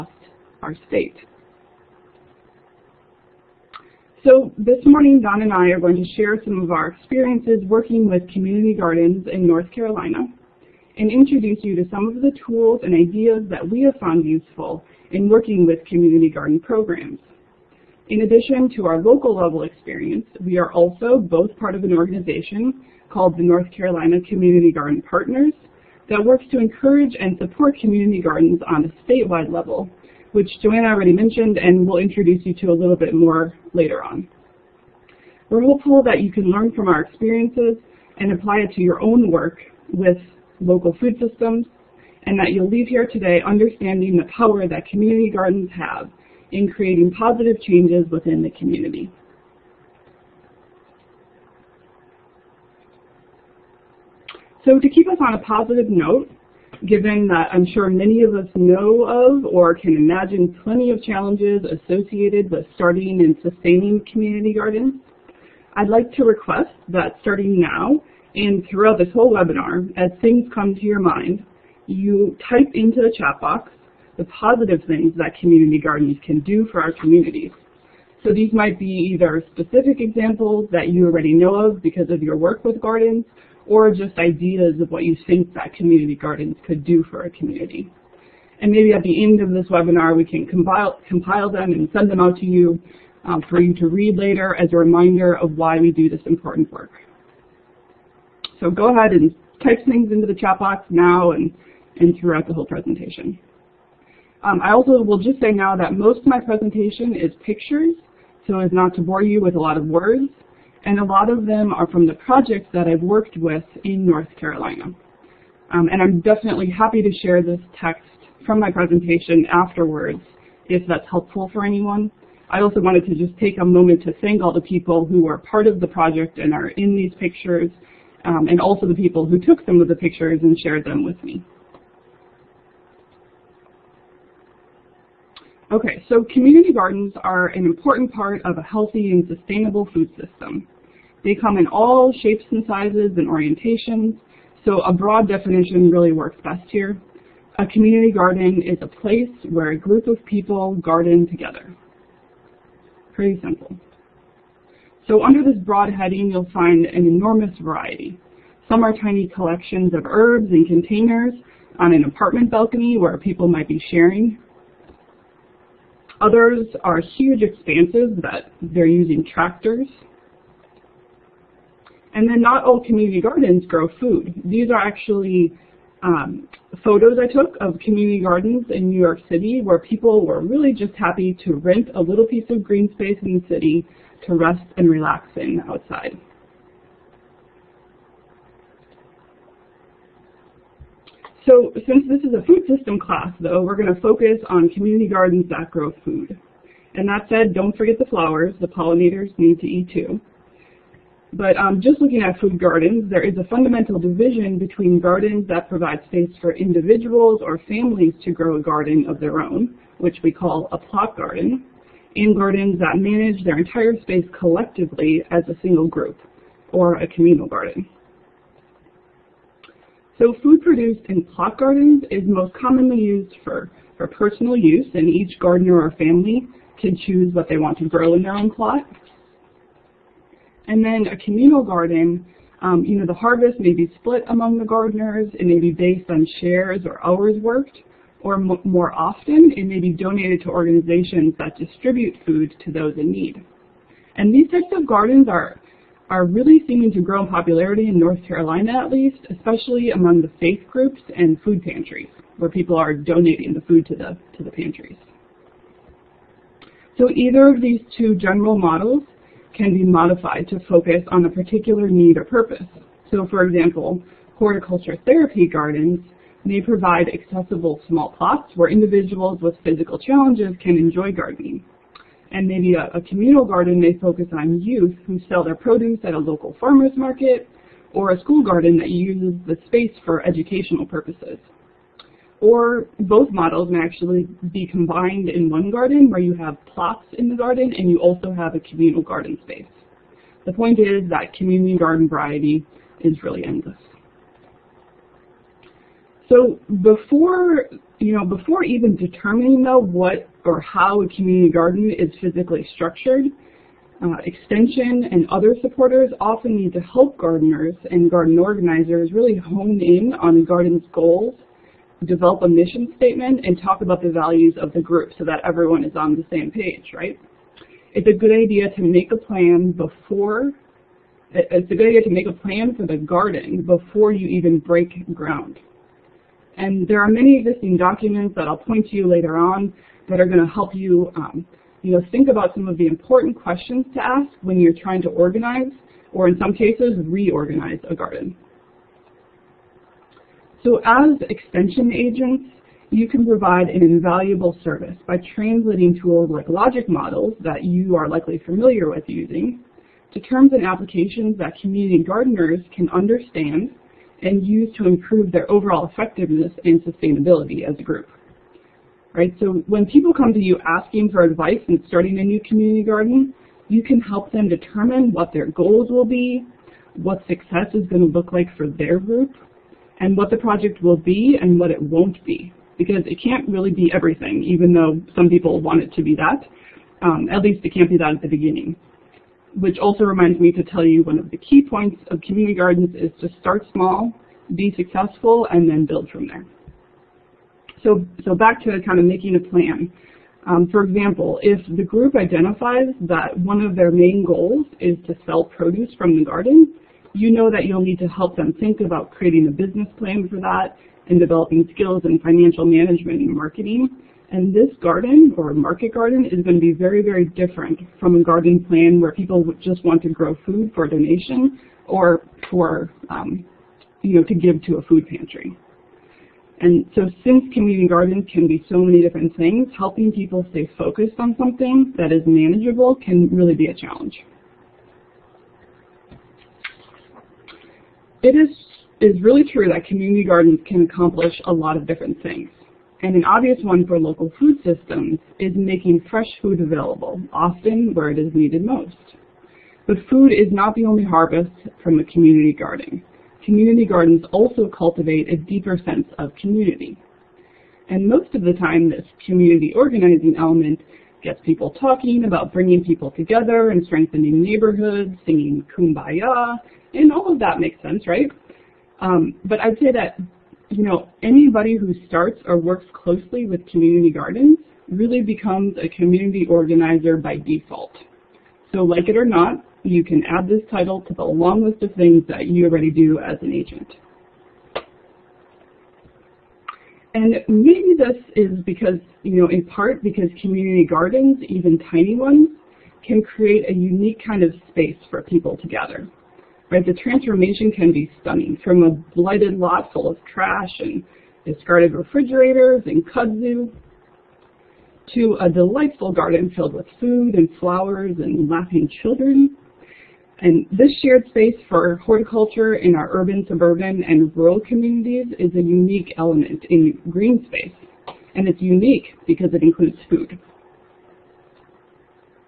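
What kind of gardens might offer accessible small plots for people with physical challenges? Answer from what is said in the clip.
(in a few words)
horticulture therapy gardens.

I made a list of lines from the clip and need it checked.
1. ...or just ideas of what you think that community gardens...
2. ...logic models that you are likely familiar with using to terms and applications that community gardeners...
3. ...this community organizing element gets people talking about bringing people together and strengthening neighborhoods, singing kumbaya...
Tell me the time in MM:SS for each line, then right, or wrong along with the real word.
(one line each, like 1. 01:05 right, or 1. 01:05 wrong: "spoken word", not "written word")
1. 01:23 right
2. 05:46 right
3. 07:28 right.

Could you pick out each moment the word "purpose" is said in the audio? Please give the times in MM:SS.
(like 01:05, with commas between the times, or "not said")
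04:22, 04:40.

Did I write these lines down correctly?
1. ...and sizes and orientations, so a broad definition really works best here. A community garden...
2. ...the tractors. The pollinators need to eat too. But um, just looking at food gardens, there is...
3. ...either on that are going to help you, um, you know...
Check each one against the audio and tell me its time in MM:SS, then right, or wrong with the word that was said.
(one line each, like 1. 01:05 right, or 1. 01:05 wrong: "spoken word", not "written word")
1. 02:22 right
2. 03:17 wrong: "flowers", not "tractors"
3. 05:29 wrong: "later", not "either".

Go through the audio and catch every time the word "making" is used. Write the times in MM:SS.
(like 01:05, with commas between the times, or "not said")
06:29, 07:15.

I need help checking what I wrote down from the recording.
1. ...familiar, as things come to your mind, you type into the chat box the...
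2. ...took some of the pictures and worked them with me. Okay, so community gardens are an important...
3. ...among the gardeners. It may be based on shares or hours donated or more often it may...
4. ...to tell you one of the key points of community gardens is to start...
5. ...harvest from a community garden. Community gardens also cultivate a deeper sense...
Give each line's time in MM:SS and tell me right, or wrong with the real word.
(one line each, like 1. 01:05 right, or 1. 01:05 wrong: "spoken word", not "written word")
1. 01:09 wrong: "webinar", not "familiar"
2. 02:09 wrong: "shared", not "worked"
3. 03:54 wrong: "worked", not "donated"
4. 06:20 right
5. 07:21 right.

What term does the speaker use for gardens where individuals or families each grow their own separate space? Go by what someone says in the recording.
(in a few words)
plot garden.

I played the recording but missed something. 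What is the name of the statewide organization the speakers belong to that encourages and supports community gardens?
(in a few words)
North Carolina Community Garden Partners.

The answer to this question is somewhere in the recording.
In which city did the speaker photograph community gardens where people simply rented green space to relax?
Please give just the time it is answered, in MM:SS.
02:58.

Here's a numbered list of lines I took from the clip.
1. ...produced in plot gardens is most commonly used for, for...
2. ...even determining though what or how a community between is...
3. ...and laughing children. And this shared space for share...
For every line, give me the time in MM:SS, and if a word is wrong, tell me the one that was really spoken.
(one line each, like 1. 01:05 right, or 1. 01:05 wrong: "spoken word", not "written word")
1. 03:40 right
2. 04:58 wrong: "garden", not "between"
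3. 08:18 wrong: "horticulture", not "share".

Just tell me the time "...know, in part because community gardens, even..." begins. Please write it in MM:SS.
07:59.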